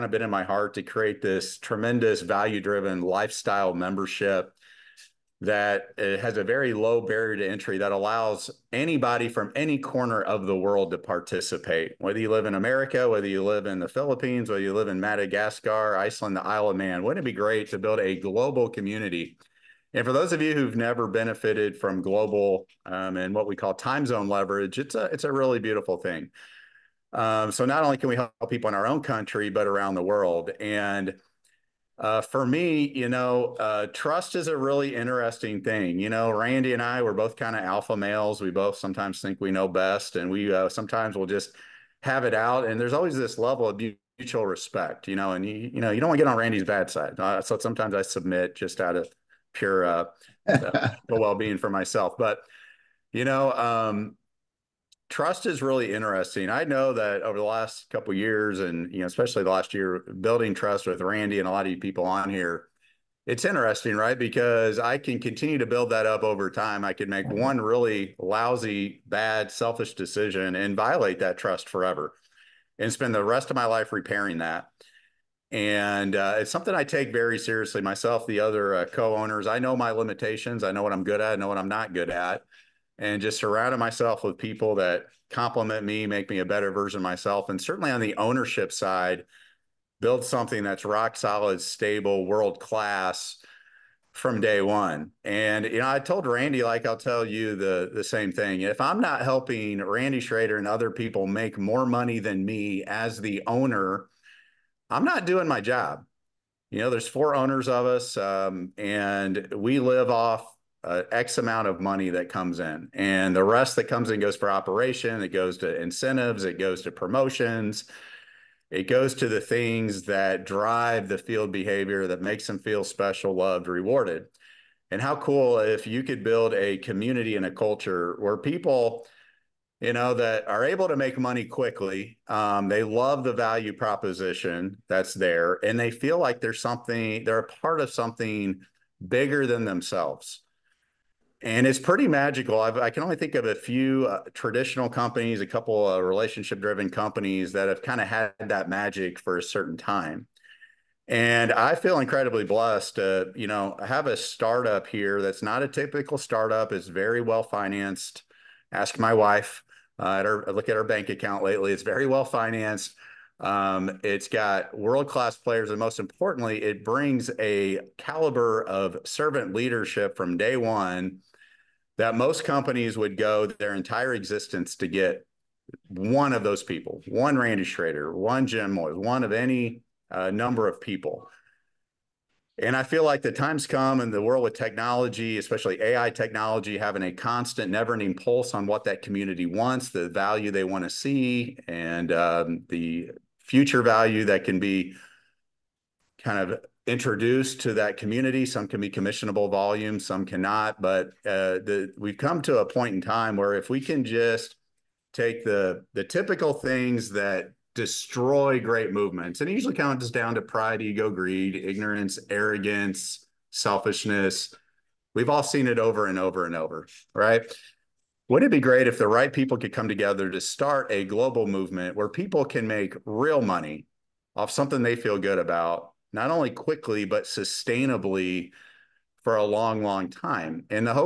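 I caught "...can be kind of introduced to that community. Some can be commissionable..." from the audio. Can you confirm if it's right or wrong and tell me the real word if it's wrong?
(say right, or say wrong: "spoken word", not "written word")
right.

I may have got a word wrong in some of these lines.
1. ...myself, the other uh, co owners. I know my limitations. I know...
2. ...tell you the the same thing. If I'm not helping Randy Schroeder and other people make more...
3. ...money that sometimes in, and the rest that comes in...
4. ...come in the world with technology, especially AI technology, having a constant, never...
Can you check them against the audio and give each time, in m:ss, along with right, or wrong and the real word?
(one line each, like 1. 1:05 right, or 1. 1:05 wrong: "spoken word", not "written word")
1. 1:17 right
2. 1:36 right
3. 1:51 wrong: "comes", not "sometimes"
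4. 3:03 right.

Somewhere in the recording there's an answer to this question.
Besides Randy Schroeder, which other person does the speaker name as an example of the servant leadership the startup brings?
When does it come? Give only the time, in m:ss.
2:58.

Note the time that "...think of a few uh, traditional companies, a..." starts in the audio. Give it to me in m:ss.
2:23.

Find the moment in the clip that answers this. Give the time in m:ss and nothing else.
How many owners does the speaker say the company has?
1:47.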